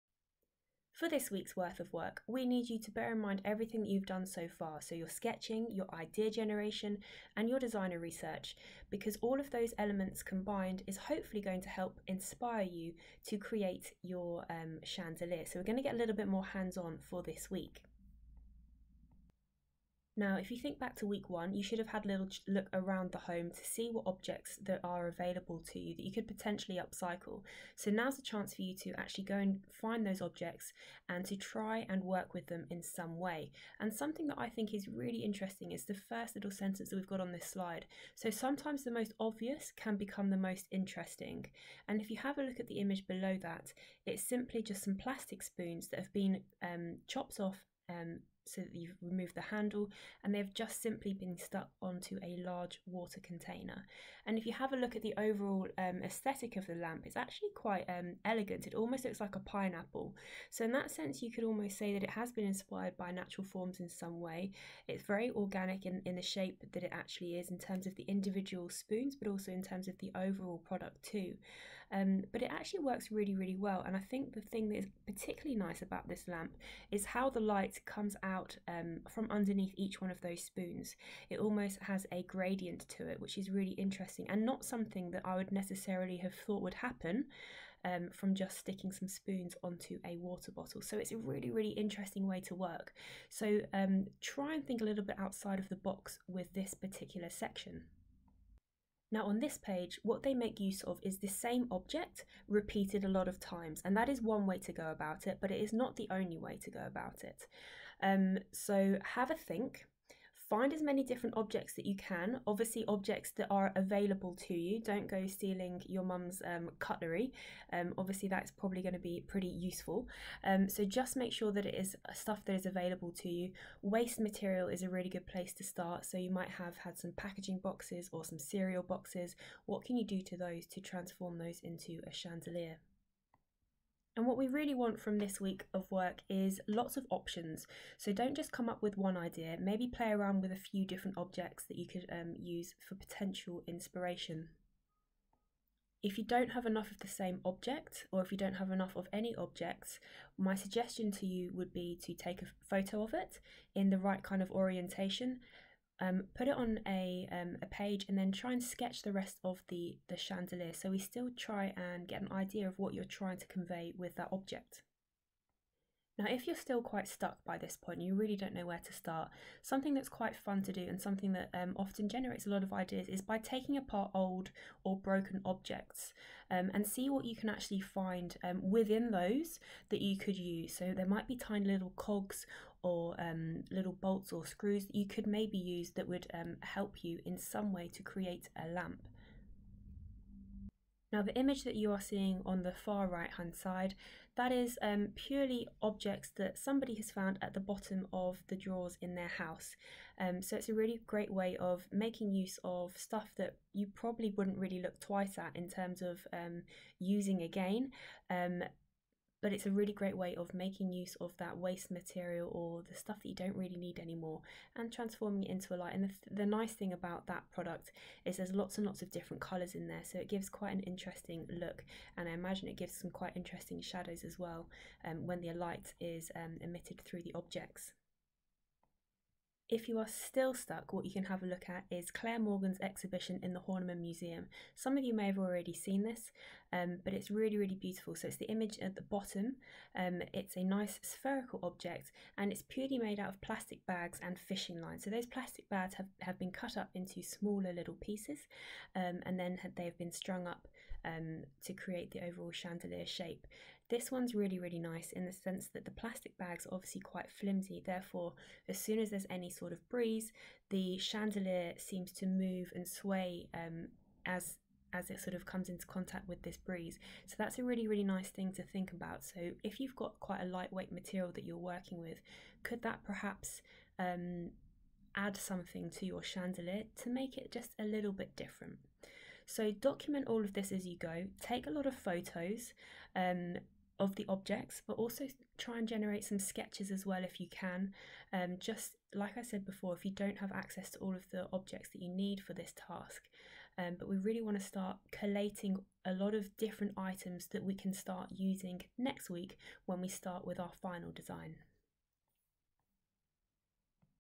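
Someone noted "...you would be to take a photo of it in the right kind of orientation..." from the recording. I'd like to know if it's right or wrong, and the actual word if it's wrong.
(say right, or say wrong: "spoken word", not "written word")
right.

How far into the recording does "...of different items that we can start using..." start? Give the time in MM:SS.
04:56.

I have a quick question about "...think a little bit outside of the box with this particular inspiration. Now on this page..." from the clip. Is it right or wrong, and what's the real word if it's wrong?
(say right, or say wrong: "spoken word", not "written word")
wrong: "section", not "inspiration".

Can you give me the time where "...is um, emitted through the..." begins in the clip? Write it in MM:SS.
03:45.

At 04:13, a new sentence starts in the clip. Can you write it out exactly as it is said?
This one's really, really nice in the sense that the plastic bags are obviously quite flimsy.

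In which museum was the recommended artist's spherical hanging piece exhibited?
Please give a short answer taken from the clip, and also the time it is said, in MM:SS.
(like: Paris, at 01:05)
Horniman Museum, at 03:53.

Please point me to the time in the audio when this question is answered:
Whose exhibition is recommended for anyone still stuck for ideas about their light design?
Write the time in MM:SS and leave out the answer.
03:52.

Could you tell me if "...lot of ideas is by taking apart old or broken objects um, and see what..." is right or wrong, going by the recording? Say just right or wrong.
right.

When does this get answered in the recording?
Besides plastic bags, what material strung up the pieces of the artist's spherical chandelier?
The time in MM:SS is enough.
04:04.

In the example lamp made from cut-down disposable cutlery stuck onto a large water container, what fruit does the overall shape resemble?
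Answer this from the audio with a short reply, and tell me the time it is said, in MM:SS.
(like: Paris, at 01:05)
Pineapple, at 00:59.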